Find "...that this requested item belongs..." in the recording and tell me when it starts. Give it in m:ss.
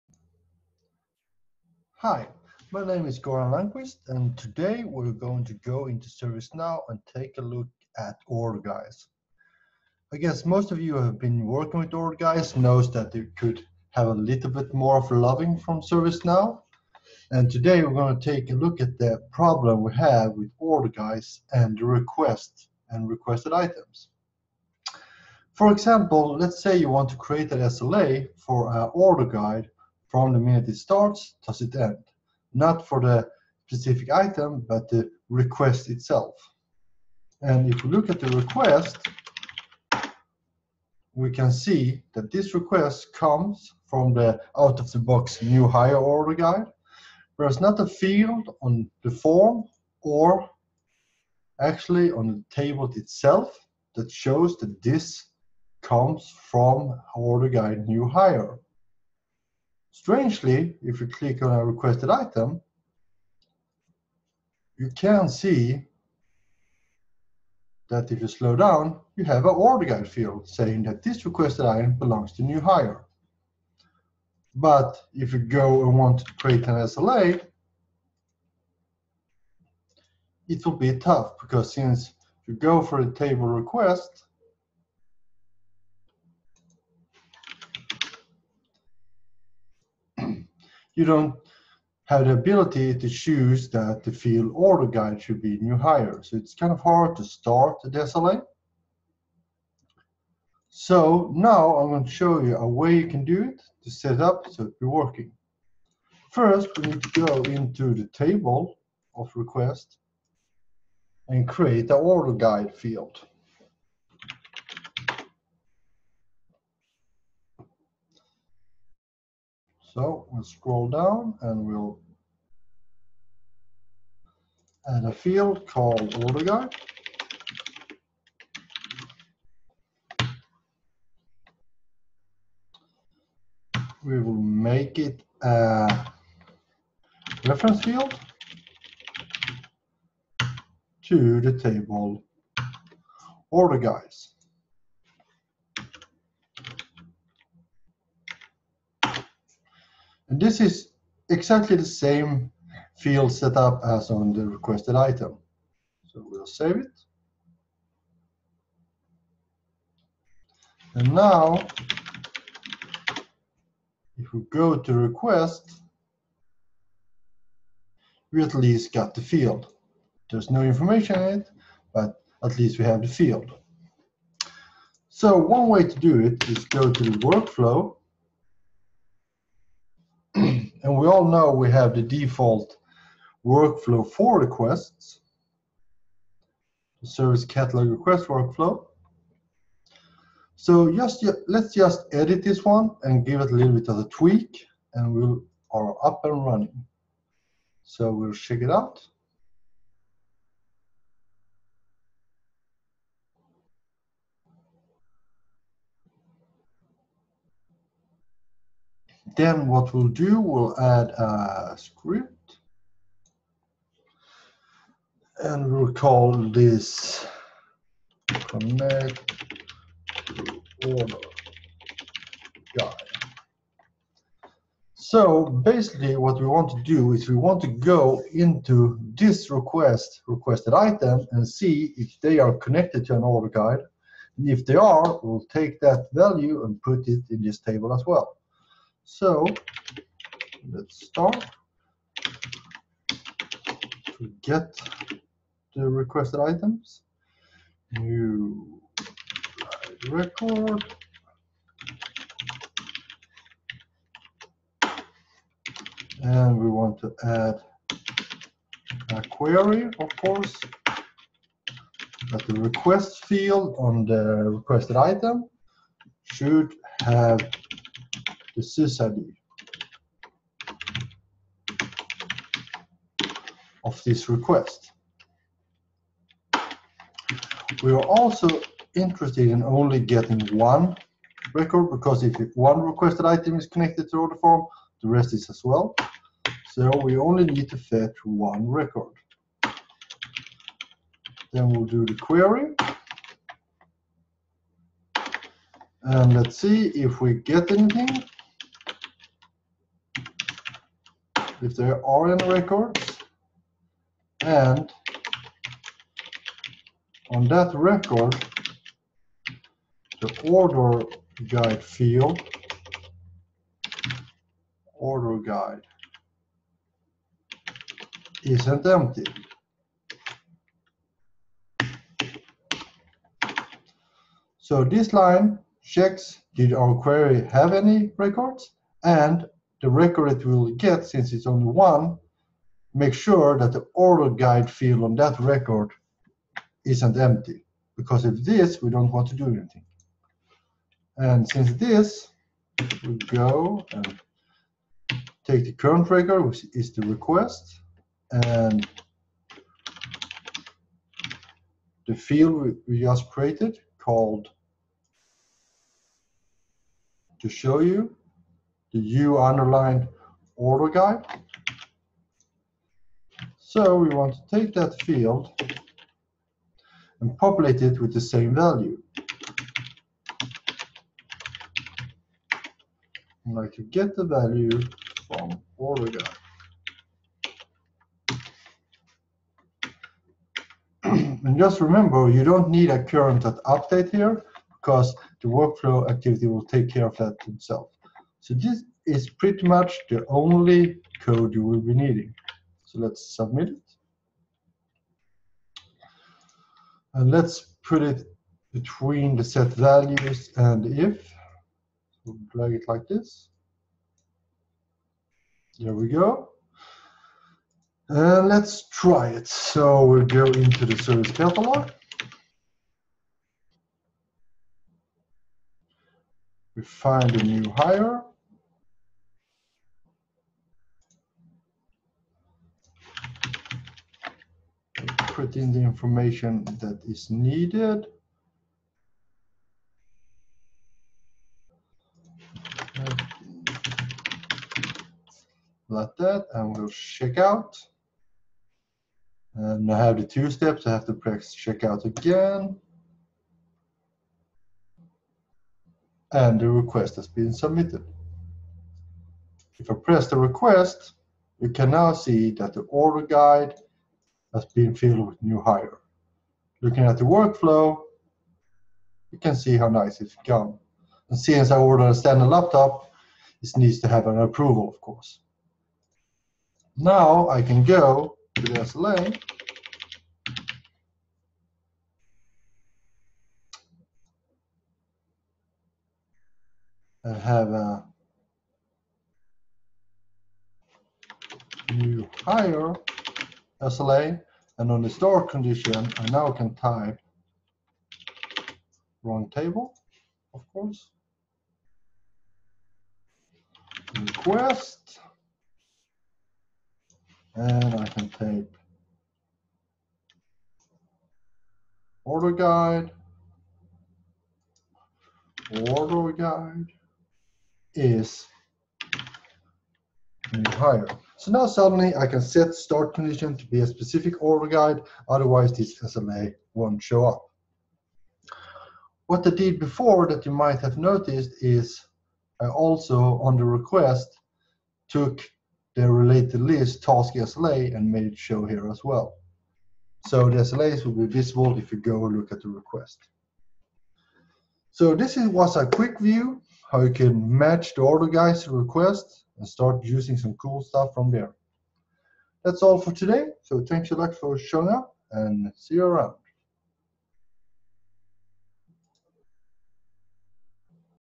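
1:10.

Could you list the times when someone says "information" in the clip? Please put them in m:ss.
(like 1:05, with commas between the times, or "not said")
2:50, 7:05.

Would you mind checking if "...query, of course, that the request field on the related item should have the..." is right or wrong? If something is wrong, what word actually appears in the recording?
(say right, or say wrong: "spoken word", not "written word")
wrong: "requested", not "related".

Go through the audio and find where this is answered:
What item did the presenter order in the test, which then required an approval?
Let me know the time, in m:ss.
7:42.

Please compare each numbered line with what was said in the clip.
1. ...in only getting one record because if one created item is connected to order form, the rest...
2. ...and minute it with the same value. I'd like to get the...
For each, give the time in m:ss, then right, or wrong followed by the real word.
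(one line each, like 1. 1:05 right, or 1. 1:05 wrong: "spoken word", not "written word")
1. 4:39 wrong: "requested", not "created"
2. 6:07 wrong: "populate", not "minute".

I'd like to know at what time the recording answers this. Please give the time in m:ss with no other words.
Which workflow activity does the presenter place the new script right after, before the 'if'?
6:39.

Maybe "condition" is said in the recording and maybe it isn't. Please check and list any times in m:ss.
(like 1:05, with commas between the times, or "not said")
8:05, 8:33.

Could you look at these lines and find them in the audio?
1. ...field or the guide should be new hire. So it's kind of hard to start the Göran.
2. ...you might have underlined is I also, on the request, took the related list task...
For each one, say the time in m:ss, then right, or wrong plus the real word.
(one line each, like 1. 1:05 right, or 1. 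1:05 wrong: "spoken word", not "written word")
1. 1:34 wrong: "SLA", not "Göran"
2. 8:40 wrong: "noticed", not "underlined".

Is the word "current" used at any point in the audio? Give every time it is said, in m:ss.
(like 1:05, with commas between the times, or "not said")
5:45, 6:23.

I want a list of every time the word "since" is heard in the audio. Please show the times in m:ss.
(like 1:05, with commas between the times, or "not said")
1:21, 5:31, 5:41, 7:41.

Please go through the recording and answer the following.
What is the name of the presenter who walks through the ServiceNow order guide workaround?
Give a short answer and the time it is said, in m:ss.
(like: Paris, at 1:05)
Göran Lundqvist, at 0:03.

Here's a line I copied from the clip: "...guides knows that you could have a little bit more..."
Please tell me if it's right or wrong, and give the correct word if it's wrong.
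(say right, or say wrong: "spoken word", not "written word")
right.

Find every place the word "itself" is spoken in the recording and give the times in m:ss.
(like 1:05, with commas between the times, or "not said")
0:35, 0:52, 6:27.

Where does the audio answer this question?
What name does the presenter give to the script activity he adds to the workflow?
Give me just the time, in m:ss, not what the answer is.
3:38.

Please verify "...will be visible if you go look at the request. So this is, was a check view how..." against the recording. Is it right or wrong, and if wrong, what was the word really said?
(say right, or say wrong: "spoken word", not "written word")
wrong: "quick", not "check".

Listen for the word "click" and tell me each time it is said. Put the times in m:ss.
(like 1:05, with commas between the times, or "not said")
1:01.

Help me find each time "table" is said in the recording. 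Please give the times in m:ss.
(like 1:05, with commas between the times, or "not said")
0:52, 1:23, 1:48, 2:21, 3:57, 8:09.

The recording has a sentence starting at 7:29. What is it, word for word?
If I press the request, you can now see that the order guide has been filled with new hire.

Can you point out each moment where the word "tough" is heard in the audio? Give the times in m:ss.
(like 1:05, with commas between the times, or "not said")
1:20.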